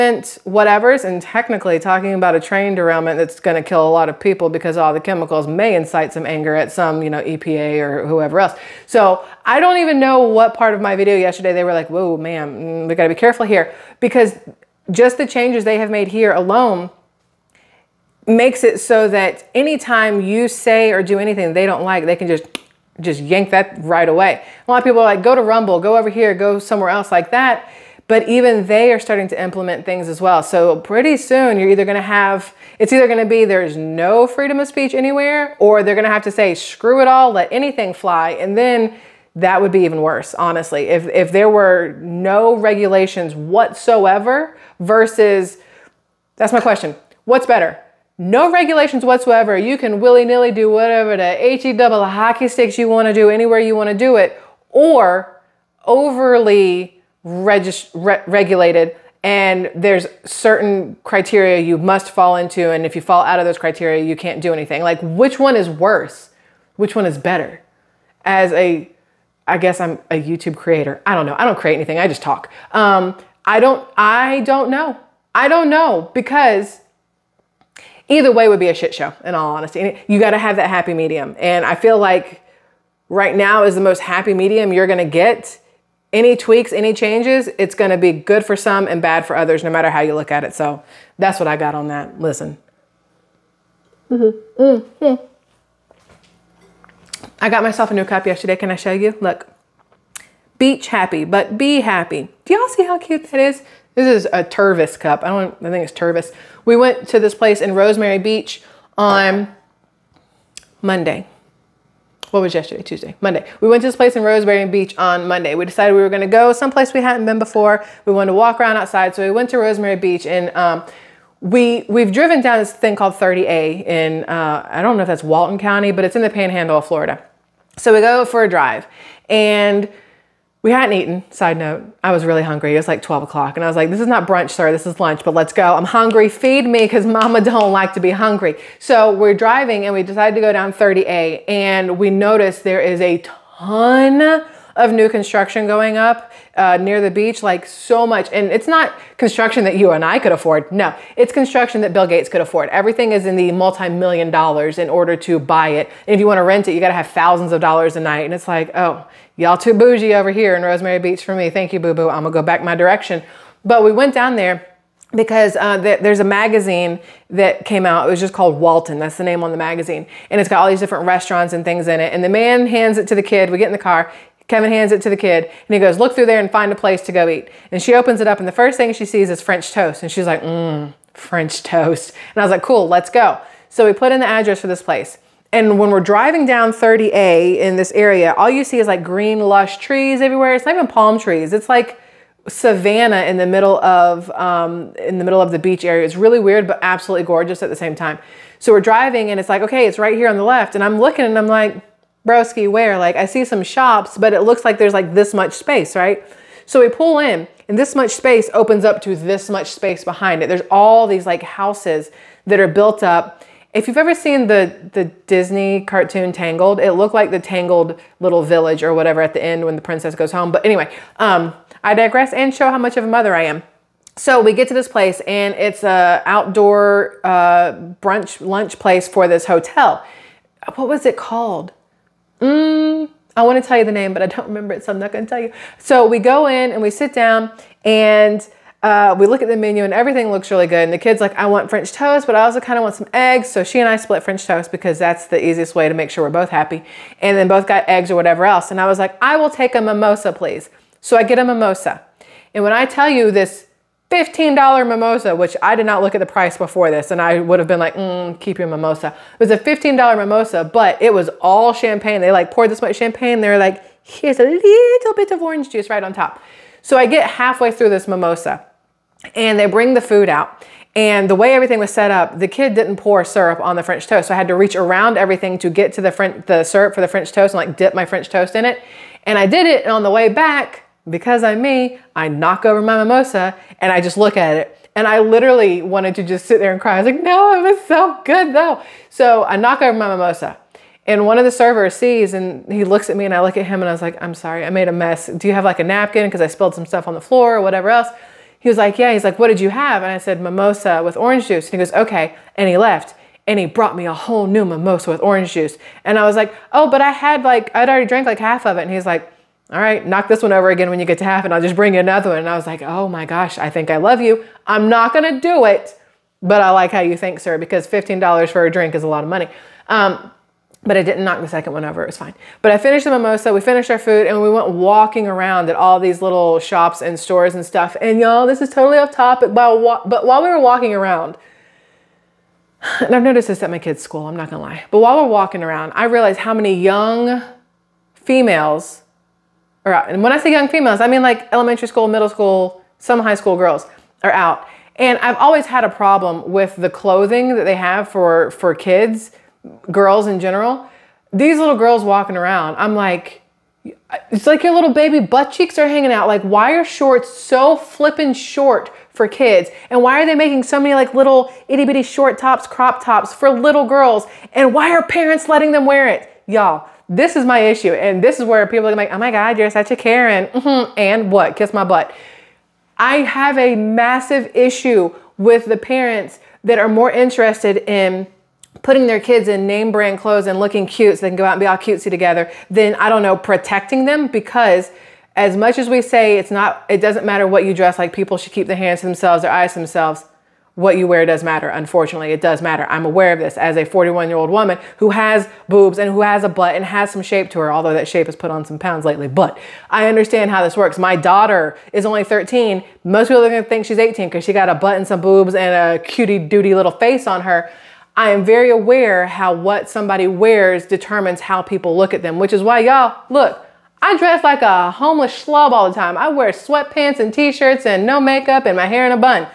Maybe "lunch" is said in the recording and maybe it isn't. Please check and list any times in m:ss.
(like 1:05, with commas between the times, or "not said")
2:14, 3:48.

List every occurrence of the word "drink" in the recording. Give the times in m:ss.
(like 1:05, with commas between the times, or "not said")
5:18.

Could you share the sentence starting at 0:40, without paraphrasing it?
If, if there were no regulations whatsoever versus, that's my question, what's better?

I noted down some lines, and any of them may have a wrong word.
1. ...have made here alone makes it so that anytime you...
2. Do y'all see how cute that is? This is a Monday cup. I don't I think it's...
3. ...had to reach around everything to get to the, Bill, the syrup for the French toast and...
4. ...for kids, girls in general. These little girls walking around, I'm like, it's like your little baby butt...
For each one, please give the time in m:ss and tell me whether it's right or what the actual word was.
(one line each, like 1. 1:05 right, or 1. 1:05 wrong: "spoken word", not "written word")
1. 0:15 right
2. 1:42 wrong: "Tervis", not "Monday"
3. 4:34 wrong: "French", not "Bill"
4. 5:48 right.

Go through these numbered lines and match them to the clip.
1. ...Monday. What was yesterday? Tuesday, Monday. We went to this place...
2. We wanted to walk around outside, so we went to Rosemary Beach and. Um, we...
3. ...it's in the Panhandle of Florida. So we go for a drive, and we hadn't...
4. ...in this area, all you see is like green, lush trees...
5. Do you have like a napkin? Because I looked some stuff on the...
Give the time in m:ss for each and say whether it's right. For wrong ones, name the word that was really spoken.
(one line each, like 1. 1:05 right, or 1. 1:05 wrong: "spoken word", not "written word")
1. 1:50 right
2. 1:58 right
3. 2:06 right
4. 3:07 right
5. 4:55 wrong: "spilled", not "looked".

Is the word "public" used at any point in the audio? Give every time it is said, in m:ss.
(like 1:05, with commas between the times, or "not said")
not said.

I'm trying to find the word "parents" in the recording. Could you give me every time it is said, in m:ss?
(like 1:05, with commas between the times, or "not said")
6:05, 6:15.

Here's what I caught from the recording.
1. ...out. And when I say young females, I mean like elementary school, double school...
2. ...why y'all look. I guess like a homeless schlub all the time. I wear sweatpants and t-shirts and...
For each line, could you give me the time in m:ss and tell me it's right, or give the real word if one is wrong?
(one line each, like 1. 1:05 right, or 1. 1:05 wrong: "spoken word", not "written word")
1. 5:39 wrong: "middle", not "double"
2. 6:52 wrong: "dress", not "guess".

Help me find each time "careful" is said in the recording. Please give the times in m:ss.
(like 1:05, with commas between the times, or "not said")
0:13.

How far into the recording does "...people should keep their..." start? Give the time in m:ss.
6:28.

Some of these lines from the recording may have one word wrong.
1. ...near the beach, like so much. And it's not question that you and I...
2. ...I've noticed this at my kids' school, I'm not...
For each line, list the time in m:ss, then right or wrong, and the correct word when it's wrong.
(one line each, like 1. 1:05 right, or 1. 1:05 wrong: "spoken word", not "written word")
1. 2:26 wrong: "construction", not "question"
2. 5:33 right.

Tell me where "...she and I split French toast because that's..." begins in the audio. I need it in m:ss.
4:03.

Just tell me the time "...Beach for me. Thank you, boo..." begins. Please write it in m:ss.
2:41.